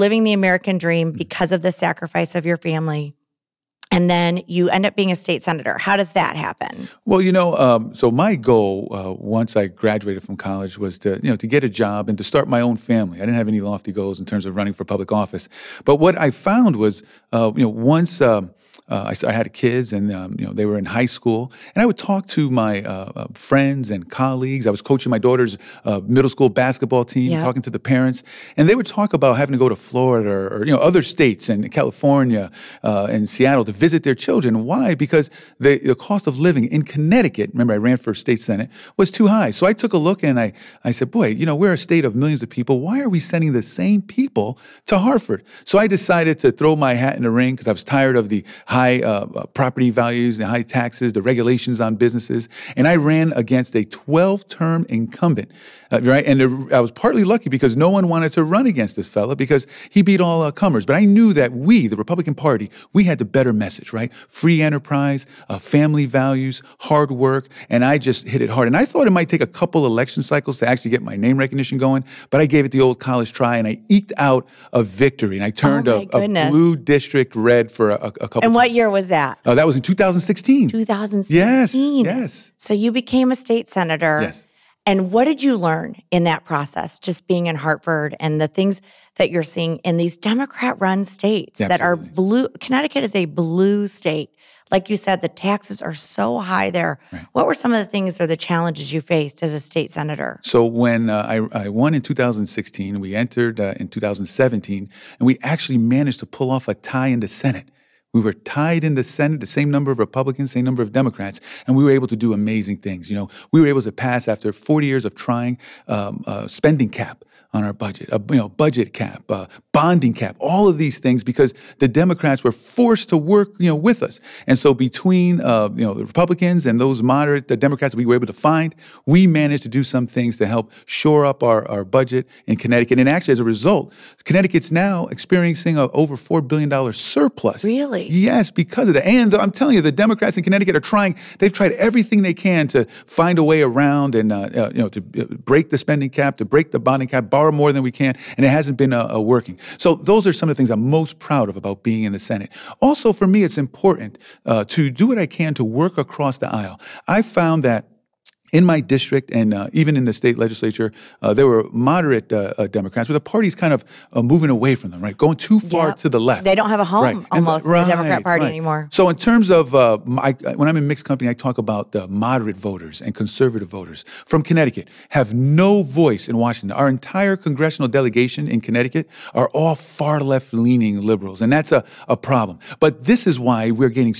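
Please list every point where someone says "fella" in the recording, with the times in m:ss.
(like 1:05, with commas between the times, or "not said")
0:59.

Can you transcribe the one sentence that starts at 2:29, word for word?
So those are some of the things I'm most proud of about being in the Senate.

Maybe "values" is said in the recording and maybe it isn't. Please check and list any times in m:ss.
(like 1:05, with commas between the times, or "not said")
0:49, 1:06.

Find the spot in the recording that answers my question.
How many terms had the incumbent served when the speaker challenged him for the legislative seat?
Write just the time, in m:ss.
0:53.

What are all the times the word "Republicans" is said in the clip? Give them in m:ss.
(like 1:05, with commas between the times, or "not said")
1:01, 1:49, 2:06.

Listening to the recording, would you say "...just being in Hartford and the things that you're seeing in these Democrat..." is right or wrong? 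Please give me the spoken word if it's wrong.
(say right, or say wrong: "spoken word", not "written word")
right.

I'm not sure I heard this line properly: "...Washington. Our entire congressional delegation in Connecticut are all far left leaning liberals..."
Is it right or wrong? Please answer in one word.
right.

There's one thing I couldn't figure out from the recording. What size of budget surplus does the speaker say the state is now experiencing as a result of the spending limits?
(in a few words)
Over $4 billion.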